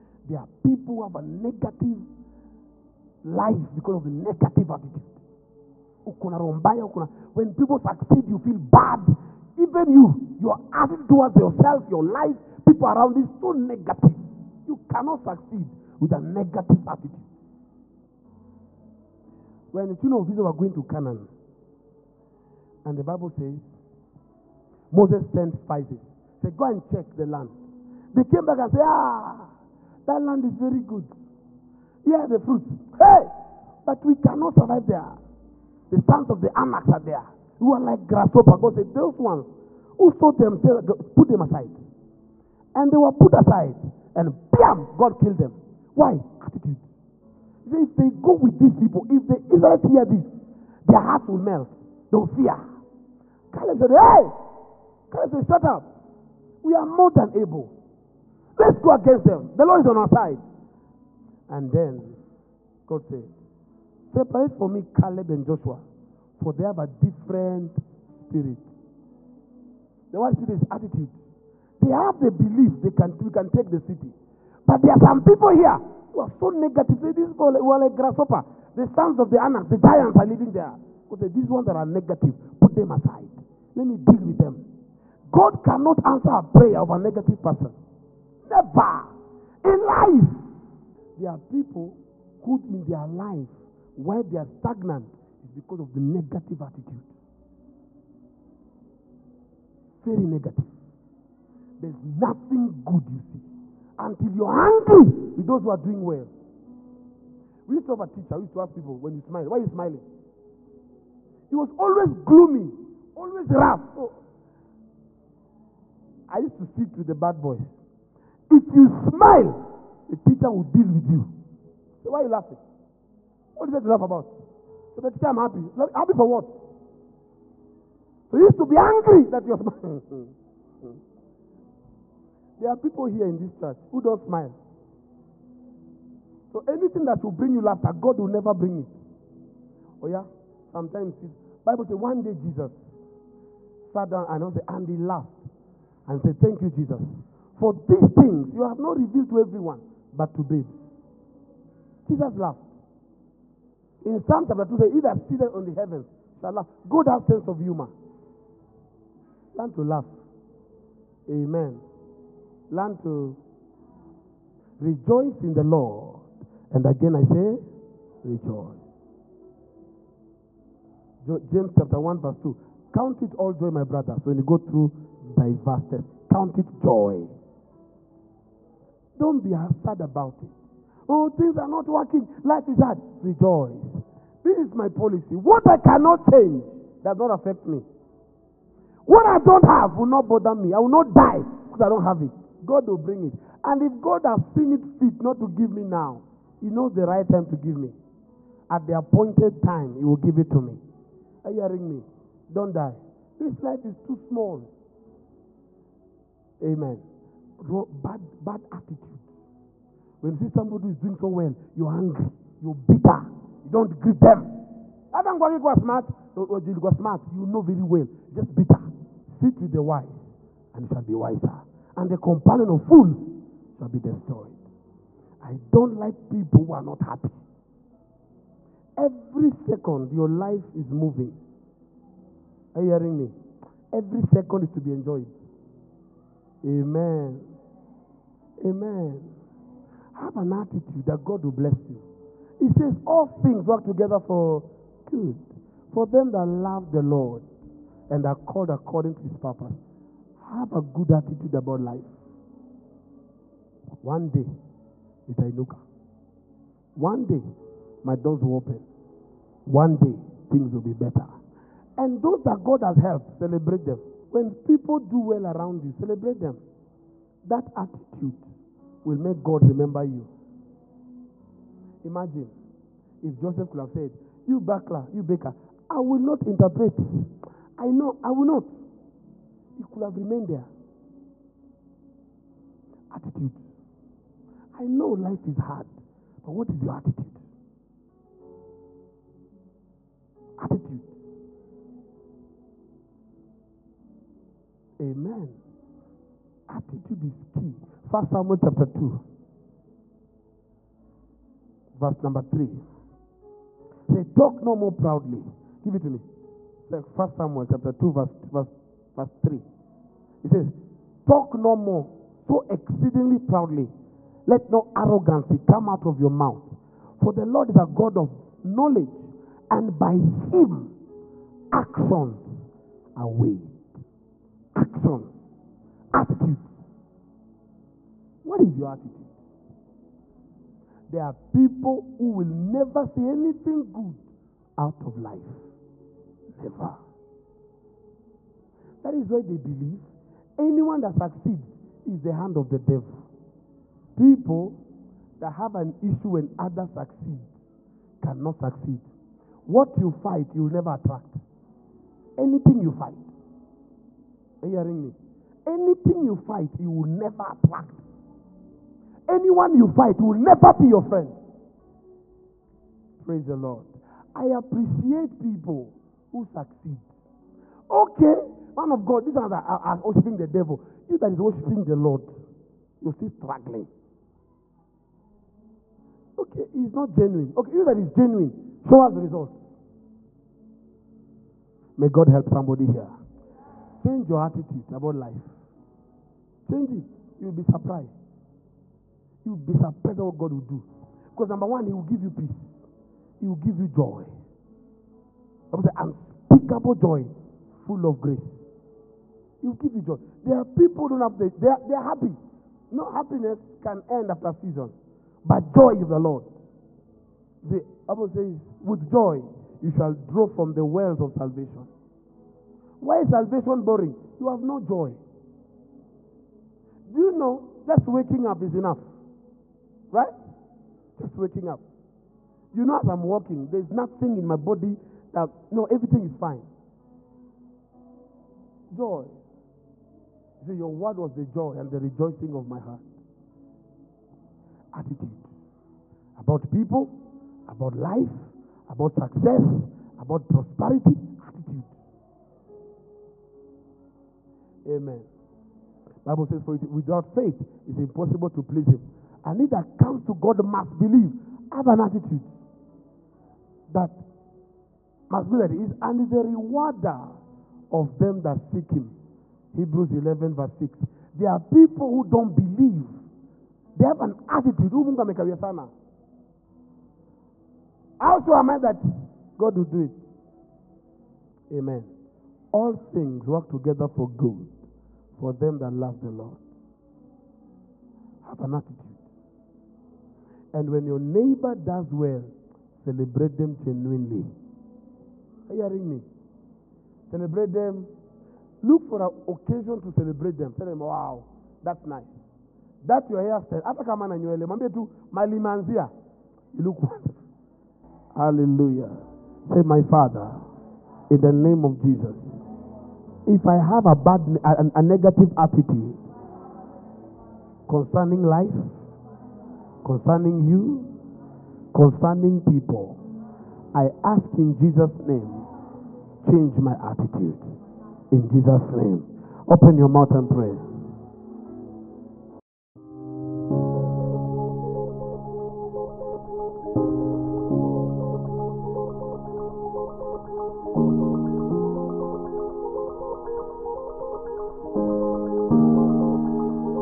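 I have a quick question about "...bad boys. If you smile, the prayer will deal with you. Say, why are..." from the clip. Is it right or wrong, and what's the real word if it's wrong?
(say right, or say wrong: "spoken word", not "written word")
wrong: "teacher", not "prayer".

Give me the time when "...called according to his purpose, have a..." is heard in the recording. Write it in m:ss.
4:08.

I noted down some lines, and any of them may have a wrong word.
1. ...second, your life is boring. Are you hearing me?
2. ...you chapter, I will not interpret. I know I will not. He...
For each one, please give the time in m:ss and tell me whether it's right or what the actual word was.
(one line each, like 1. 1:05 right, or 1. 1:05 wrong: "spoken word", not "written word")
1. 3:49 wrong: "moving", not "boring"
2. 4:35 wrong: "baker", not "chapter".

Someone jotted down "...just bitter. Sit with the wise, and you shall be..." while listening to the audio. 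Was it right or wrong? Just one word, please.
right.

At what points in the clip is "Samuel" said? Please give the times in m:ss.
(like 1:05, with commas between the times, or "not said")
4:58, 5:07.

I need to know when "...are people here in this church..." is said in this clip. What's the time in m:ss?
2:12.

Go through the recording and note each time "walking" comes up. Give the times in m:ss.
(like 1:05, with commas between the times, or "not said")
7:03.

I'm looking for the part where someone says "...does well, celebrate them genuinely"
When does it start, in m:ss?
8:01.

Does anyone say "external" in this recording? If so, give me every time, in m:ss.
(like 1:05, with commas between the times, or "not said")
not said.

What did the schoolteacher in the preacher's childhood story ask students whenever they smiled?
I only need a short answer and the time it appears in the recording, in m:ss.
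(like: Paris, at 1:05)
Why are you smiling?, at 1:49.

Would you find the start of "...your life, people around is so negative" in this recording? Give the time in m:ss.
0:11.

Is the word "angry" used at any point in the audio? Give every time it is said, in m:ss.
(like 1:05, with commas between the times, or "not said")
1:44, 2:08, 3:31.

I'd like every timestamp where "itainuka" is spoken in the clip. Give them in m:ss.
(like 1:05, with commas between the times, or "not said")
4:15.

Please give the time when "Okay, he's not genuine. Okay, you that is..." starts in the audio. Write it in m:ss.
6:16.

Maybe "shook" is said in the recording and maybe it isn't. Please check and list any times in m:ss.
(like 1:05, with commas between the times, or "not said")
not said.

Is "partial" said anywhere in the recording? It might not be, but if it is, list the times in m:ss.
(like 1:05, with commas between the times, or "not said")
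not said.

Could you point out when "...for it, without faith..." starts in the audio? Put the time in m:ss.
7:26.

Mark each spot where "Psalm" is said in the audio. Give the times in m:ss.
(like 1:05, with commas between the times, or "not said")
2:34.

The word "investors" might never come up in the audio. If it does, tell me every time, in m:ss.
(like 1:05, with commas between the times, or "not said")
not said.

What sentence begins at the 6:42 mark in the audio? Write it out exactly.
No happiness can end after season, but joy is the Lord.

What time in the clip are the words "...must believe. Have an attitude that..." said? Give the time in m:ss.
7:30.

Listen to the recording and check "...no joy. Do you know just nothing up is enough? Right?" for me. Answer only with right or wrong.
wrong.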